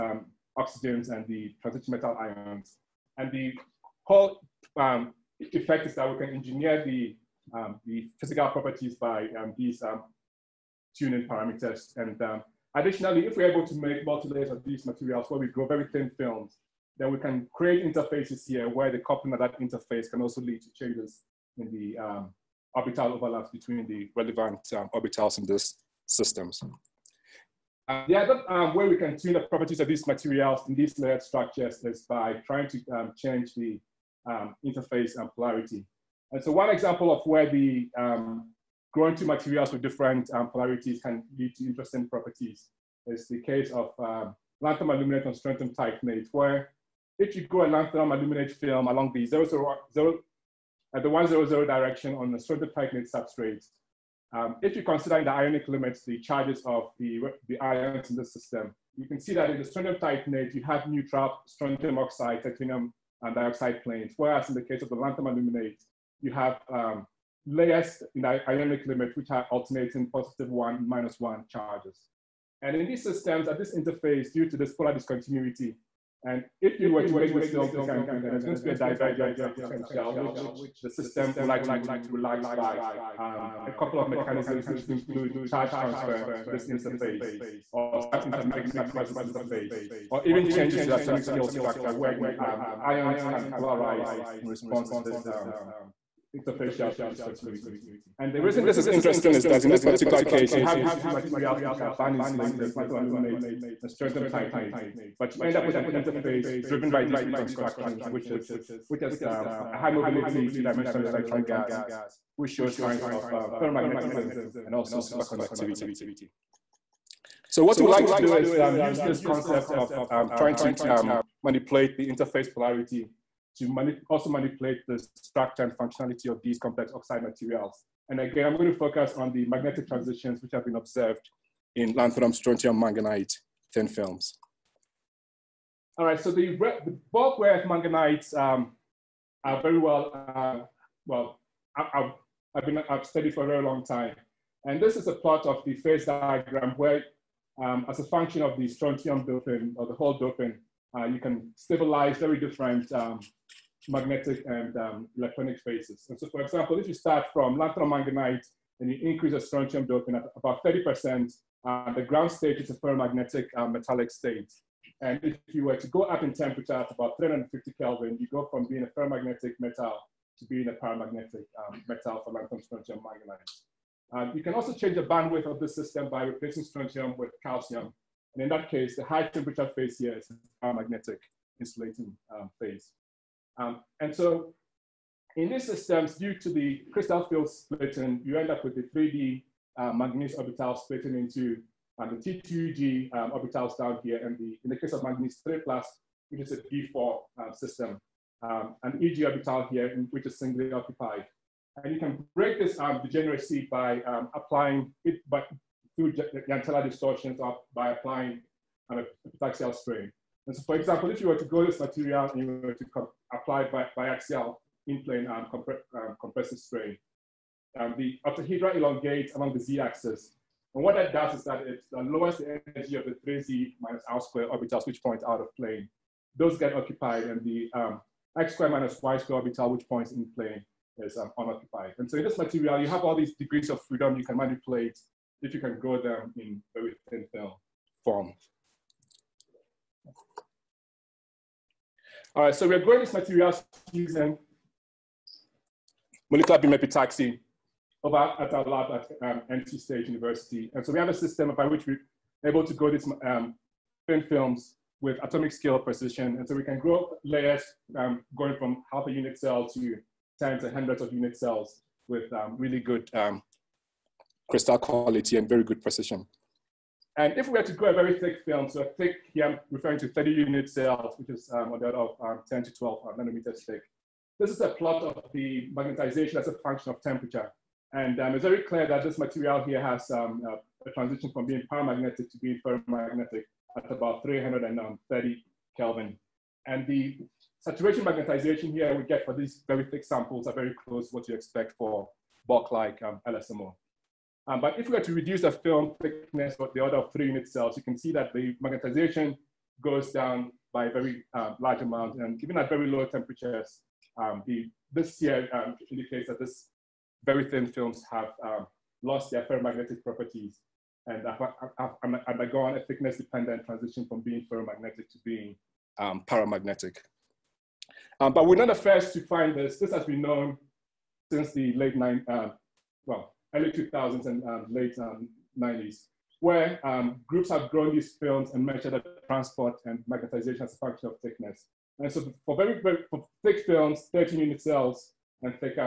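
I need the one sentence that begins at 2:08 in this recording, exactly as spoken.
And again, I'm going to focus on the magnetic transitions which have been observed in lanthanum, strontium, manganite thin films.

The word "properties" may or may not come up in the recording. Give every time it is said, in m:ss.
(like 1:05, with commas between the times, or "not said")
0:08, 0:29, 0:42, 5:10.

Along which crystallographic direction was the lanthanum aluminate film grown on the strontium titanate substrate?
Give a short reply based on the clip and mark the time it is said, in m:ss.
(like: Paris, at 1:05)
100, at 0:51.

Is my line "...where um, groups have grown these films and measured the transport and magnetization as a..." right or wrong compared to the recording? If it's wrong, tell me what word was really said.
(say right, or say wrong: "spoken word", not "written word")
right.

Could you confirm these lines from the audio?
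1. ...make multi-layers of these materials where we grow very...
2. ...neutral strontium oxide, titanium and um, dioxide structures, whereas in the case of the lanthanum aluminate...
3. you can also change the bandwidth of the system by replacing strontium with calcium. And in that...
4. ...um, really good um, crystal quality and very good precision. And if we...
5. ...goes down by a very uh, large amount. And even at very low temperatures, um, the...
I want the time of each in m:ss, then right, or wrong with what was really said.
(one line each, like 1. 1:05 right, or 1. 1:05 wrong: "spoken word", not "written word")
1. 0:13 right
2. 1:00 wrong: "planes", not "structures"
3. 2:54 right
4. 4:22 right
5. 4:59 right.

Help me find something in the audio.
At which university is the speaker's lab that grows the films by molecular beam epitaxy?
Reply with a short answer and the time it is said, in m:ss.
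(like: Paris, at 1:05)
NC State University, at 4:09.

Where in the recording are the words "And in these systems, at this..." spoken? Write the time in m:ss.
1:12.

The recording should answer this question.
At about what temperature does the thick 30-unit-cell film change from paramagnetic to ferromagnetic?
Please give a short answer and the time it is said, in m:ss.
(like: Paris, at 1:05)
330 Kelvin, at 4:44.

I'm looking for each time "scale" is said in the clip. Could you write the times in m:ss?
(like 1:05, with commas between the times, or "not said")
1:31, 4:15.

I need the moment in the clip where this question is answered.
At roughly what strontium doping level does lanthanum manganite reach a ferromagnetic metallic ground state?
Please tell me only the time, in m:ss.
2:40.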